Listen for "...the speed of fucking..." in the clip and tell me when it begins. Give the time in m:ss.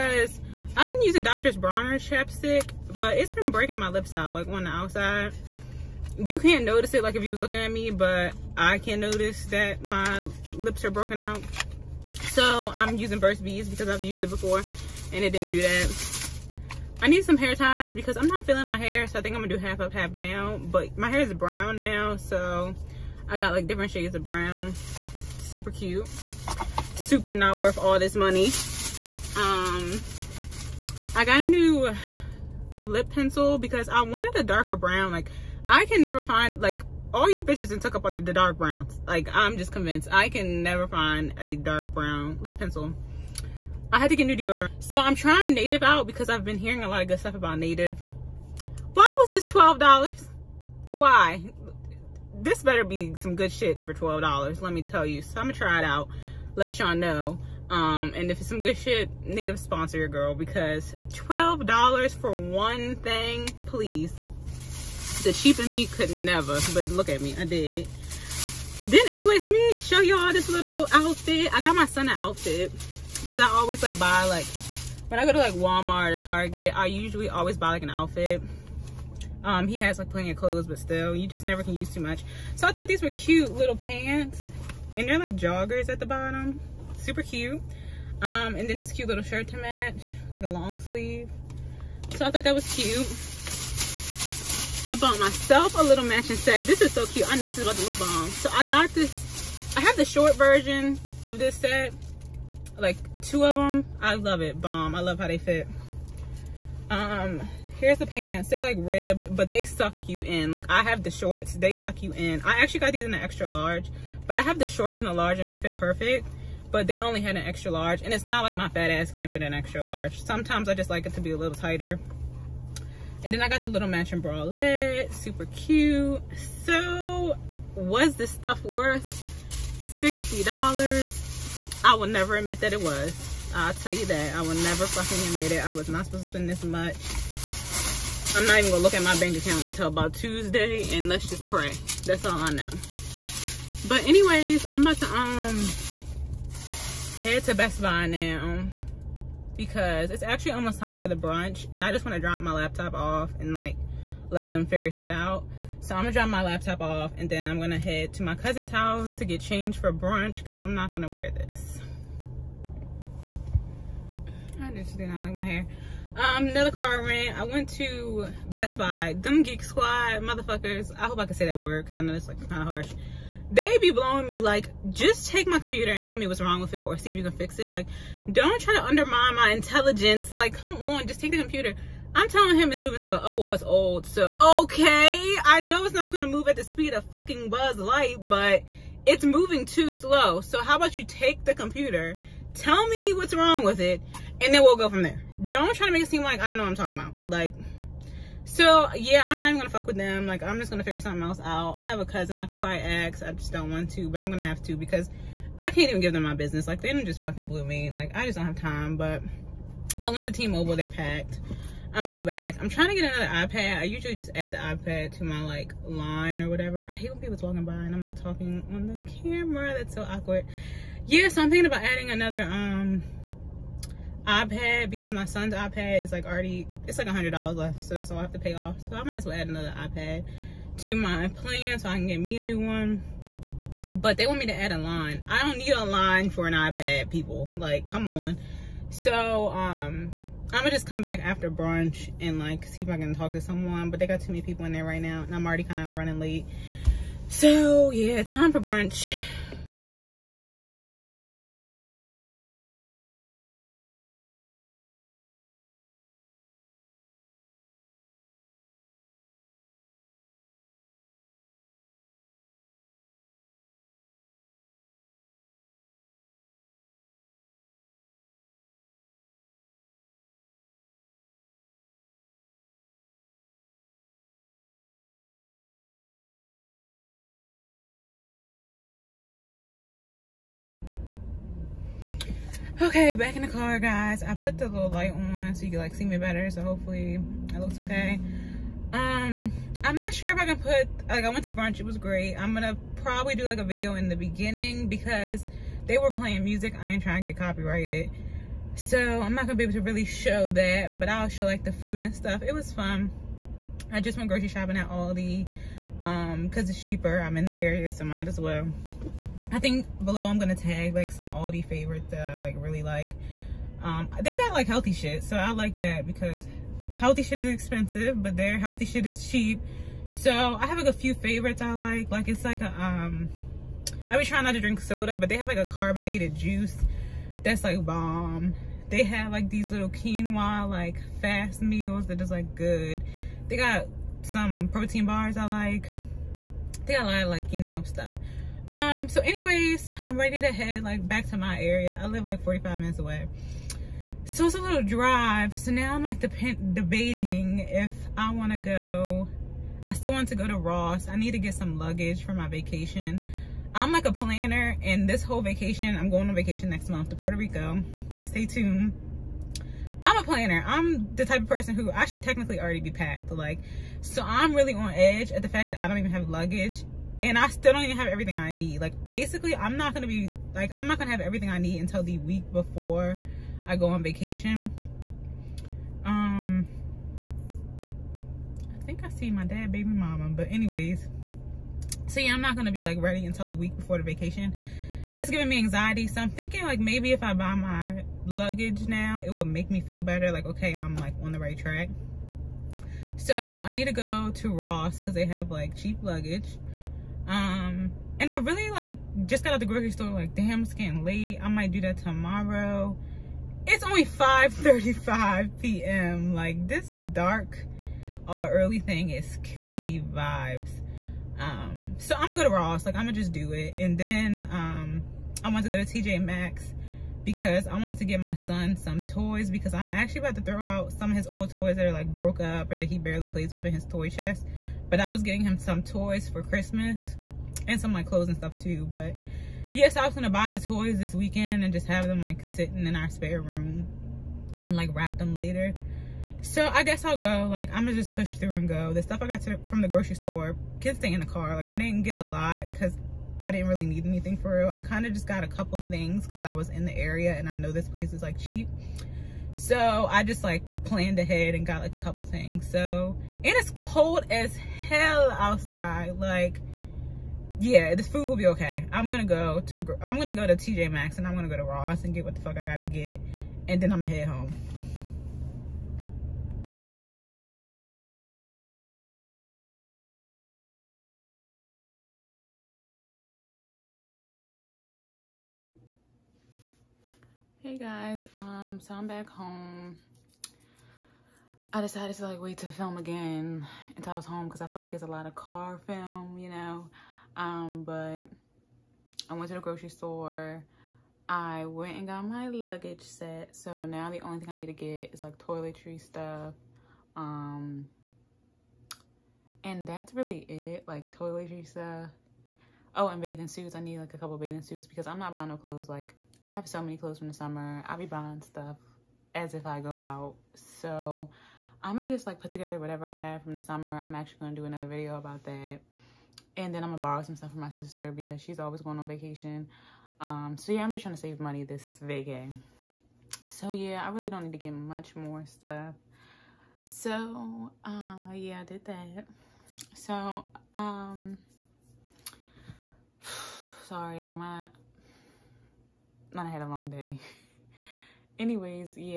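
3:06.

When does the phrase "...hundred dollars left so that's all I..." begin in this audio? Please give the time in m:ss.
3:47.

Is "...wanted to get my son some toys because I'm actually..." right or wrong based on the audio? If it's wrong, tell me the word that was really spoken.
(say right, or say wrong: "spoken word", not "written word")
right.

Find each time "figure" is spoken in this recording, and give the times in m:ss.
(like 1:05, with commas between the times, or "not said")
2:34, 3:20.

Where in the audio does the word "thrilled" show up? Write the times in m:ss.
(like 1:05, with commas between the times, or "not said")
not said.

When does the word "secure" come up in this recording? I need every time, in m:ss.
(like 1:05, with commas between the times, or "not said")
not said.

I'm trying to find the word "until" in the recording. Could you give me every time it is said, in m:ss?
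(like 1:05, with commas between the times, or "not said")
2:19, 6:11, 6:23, 8:03.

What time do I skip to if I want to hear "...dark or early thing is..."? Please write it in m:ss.
6:47.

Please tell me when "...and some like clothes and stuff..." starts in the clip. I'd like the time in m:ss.
7:07.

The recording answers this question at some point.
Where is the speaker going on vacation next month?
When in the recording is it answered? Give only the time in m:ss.
5:57.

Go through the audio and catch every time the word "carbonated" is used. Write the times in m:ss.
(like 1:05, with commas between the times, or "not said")
5:25.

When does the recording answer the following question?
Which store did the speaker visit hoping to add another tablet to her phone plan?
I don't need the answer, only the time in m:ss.
3:30.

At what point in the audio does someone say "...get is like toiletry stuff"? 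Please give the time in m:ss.
8:14.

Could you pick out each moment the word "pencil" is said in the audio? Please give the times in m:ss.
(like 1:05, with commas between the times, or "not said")
0:33, 0:42.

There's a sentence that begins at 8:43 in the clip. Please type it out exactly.
So yeah, I really don't need to get much more stuff.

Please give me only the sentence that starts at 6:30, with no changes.
Like okay, I'm like on the right track.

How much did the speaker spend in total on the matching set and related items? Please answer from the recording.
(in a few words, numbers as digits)
$60.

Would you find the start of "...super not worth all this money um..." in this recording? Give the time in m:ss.
0:26.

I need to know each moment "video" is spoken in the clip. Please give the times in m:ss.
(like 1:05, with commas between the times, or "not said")
4:53, 8:34.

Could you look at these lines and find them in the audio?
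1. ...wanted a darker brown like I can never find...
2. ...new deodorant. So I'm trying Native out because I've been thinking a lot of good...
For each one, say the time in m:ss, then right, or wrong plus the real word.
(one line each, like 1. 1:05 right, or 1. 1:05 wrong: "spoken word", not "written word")
1. 0:33 right
2. 0:44 wrong: "hearing", not "thinking".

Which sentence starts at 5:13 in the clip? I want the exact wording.
Um, they got like healthy shit, so I like that because healthy shit is expensive, but their healthy shit is cheap.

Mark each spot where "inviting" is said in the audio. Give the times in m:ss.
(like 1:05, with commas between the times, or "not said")
not said.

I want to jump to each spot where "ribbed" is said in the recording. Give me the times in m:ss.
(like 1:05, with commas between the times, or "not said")
1:48.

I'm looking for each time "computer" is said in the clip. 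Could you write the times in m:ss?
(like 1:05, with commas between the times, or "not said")
2:55, 3:01, 3:11.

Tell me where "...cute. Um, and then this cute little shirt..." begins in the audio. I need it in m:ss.
1:27.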